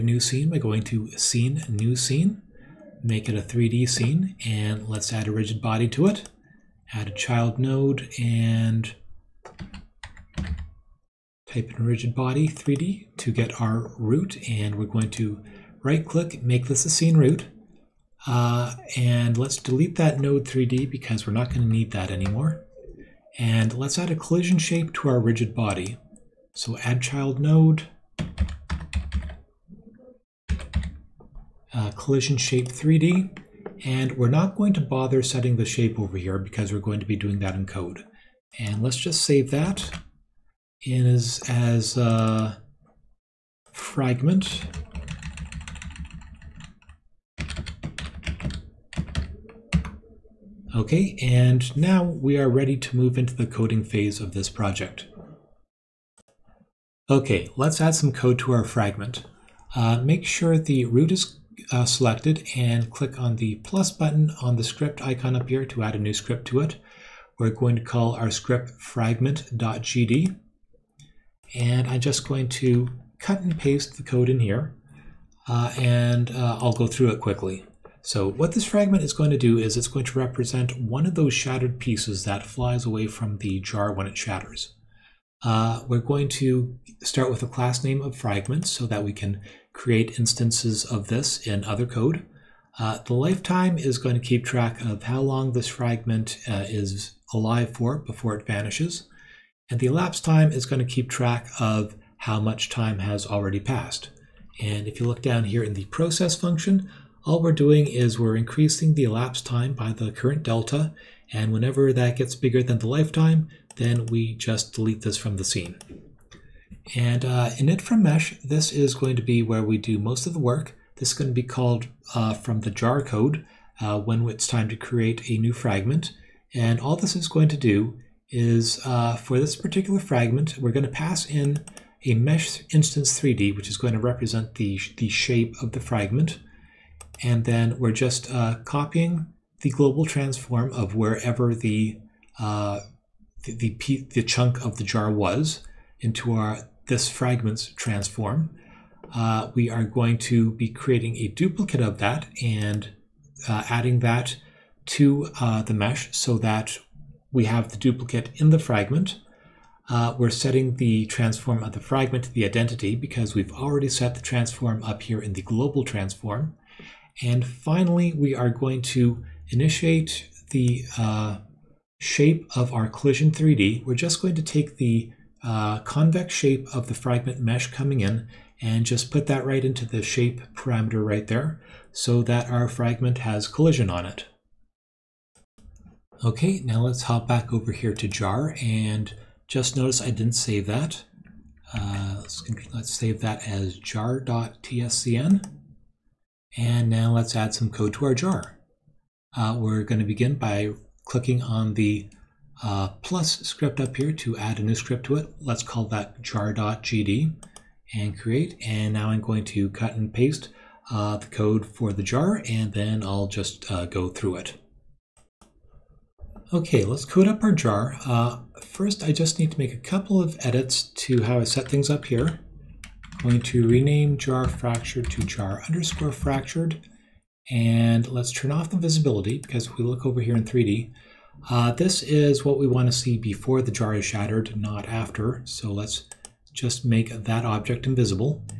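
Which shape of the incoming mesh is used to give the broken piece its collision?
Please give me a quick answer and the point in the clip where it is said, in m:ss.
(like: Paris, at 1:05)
convex shape, at 2:55.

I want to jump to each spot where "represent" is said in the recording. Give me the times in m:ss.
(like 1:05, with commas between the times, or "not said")
1:20, 2:13.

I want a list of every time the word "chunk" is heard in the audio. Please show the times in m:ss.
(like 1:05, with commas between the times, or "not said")
2:24.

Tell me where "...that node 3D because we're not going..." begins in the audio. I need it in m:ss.
0:19.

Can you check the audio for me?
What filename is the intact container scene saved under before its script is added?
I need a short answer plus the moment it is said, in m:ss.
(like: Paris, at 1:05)
jar.tscn, at 3:13.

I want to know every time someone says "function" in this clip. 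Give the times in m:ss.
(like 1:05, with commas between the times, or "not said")
1:46.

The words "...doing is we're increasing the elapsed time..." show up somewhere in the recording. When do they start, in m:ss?
1:47.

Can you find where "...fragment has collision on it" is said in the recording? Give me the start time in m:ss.
3:02.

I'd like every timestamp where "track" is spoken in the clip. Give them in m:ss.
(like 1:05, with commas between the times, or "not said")
1:34, 1:41.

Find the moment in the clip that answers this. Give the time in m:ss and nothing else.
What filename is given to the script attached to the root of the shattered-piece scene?
1:08.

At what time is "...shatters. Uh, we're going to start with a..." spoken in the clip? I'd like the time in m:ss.
1:24.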